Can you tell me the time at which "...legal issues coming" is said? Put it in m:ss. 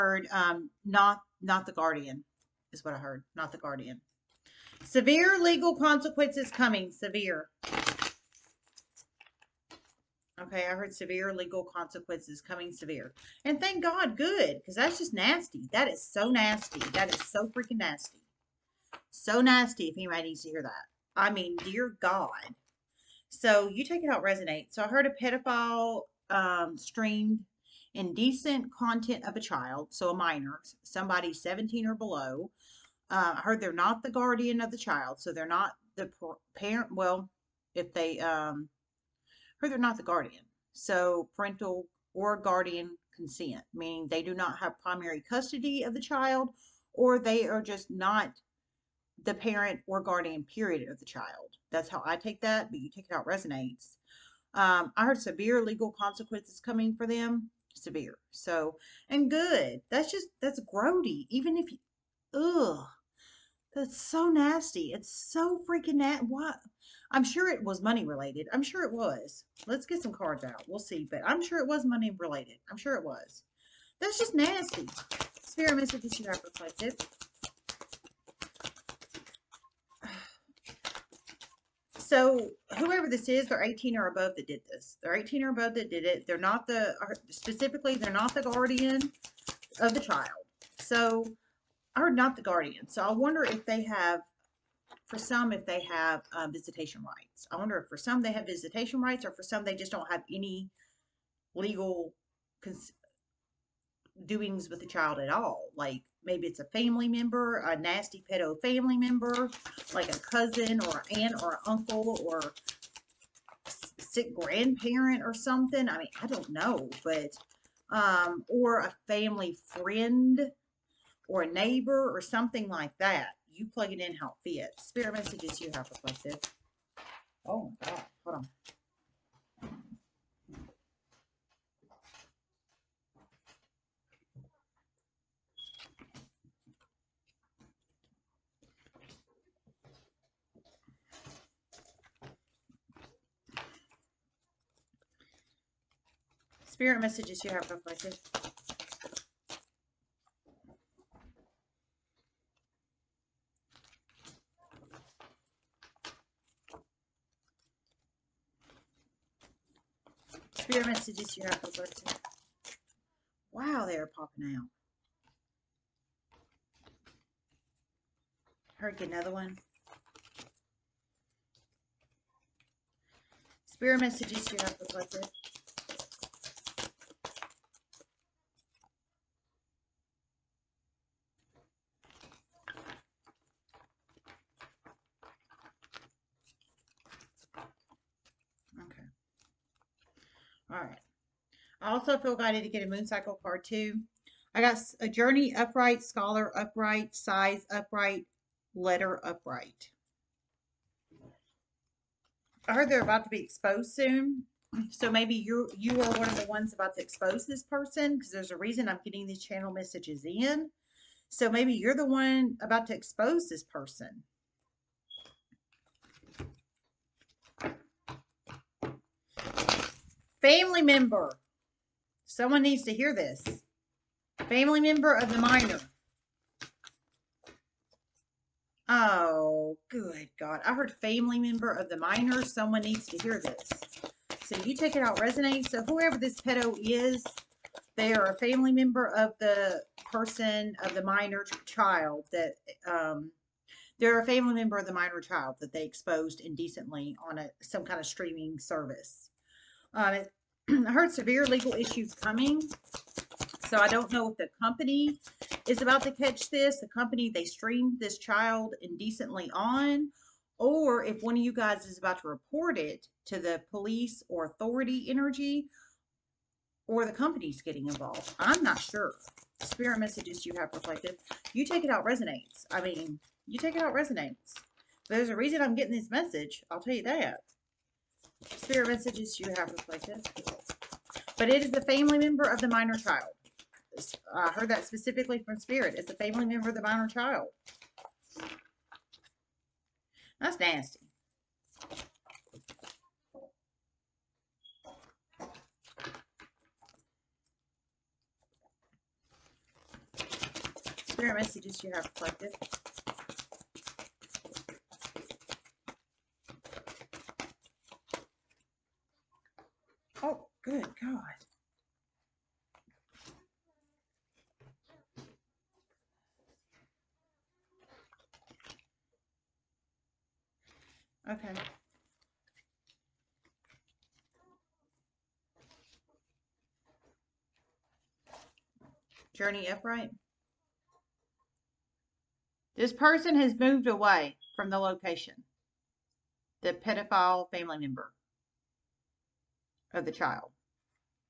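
4:11.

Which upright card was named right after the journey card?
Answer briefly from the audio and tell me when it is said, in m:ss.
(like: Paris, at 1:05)
Scholar, at 3:16.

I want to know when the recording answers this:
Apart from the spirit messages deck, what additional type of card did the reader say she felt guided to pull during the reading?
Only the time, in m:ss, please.
3:12.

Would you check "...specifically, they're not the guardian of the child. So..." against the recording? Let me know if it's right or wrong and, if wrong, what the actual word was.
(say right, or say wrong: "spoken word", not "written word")
right.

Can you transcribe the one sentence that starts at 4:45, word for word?
It's the family member of the minor child.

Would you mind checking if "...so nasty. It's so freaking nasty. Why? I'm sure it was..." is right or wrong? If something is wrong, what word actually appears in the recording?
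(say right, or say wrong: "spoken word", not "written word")
right.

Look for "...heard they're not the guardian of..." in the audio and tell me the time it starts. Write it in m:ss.
0:33.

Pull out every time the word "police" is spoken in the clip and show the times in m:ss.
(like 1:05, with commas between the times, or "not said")
4:23.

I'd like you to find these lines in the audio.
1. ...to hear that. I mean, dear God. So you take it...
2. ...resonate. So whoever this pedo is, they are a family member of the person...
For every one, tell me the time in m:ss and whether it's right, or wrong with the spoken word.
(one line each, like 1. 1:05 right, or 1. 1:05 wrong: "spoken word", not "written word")
1. 0:20 right
2. 3:55 right.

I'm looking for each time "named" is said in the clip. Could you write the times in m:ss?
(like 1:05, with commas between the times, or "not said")
not said.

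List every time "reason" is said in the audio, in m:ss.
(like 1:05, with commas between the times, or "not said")
3:28, 4:35.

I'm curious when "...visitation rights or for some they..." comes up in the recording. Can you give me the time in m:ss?
1:38.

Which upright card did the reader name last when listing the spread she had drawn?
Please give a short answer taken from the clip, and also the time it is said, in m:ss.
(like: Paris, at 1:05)
Letter, at 3:18.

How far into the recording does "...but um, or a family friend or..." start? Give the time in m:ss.
1:57.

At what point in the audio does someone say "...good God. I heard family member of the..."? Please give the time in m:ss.
3:49.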